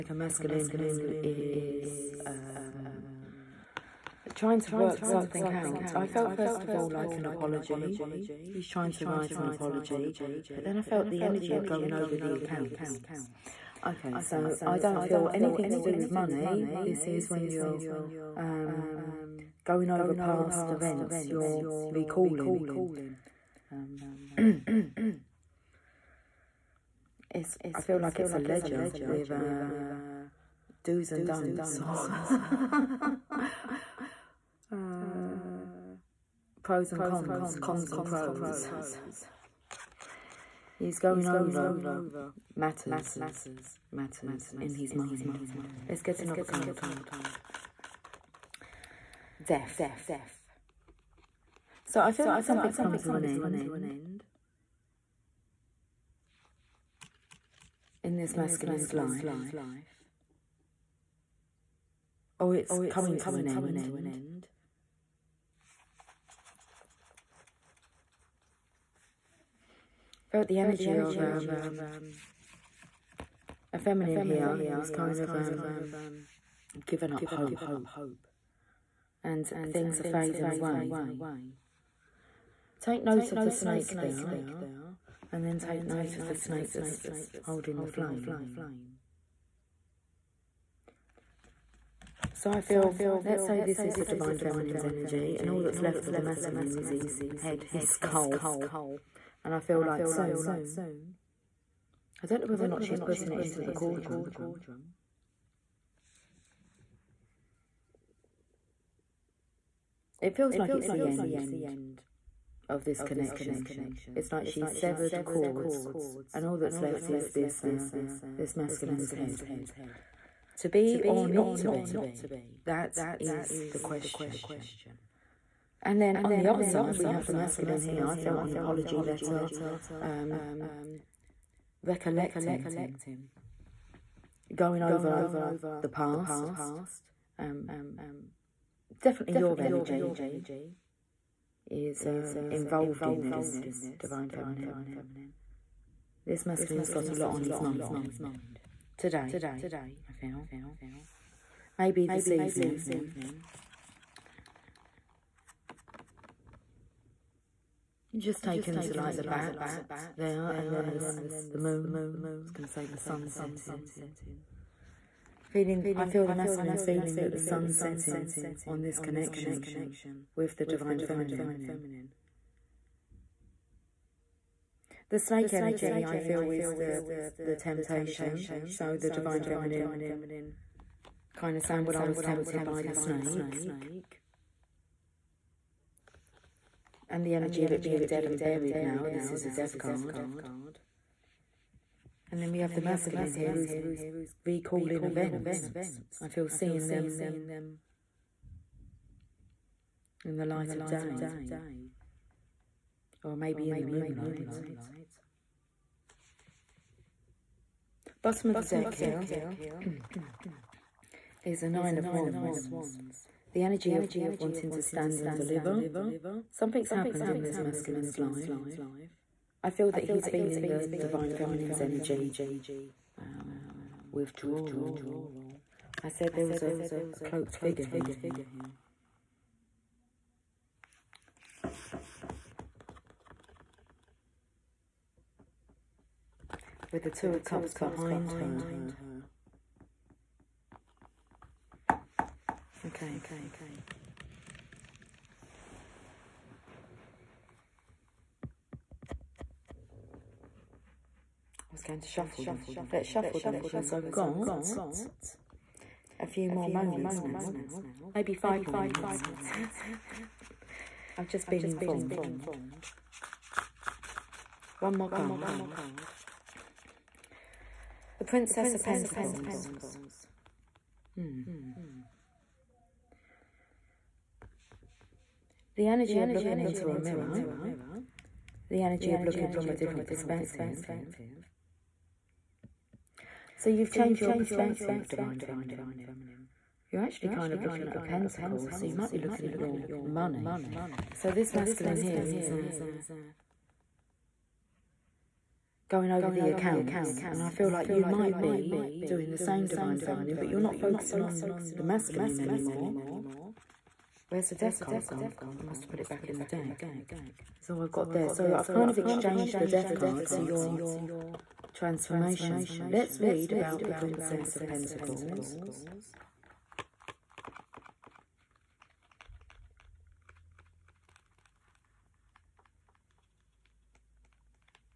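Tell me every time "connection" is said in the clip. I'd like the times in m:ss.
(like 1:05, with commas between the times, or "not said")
1:53, 2:48.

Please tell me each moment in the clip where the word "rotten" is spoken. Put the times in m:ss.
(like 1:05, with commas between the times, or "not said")
not said.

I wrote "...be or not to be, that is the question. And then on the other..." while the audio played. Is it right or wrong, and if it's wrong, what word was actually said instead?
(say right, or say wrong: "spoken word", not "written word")
right.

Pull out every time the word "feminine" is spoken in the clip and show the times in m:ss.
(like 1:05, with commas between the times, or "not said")
1:13, 1:34, 2:24, 2:51, 2:59, 3:41, 4:45, 5:00.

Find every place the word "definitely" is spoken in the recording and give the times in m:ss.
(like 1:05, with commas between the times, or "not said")
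2:19.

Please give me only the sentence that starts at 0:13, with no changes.
Okay, so I don't feel anything to do with money.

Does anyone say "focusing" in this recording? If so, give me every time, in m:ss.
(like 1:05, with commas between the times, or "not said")
5:00.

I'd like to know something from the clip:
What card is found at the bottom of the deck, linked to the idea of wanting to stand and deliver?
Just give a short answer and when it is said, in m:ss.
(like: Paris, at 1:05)
Nine of Wands, at 3:31.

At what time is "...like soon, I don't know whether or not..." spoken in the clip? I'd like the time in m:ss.
1:39.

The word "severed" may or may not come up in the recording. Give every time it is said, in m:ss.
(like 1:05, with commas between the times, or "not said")
1:54.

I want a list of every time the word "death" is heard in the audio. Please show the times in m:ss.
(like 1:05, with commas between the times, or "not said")
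0:49, 3:09, 5:04, 5:09.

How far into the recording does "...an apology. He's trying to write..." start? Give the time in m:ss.
0:07.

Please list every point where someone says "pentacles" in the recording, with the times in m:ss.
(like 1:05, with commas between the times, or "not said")
4:28, 4:47, 5:14.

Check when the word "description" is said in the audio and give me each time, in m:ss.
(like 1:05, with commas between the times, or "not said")
not said.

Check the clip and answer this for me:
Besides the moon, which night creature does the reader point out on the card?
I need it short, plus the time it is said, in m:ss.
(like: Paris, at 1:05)
Bat, at 2:39.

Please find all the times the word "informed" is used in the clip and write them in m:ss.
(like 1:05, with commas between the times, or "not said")
4:21.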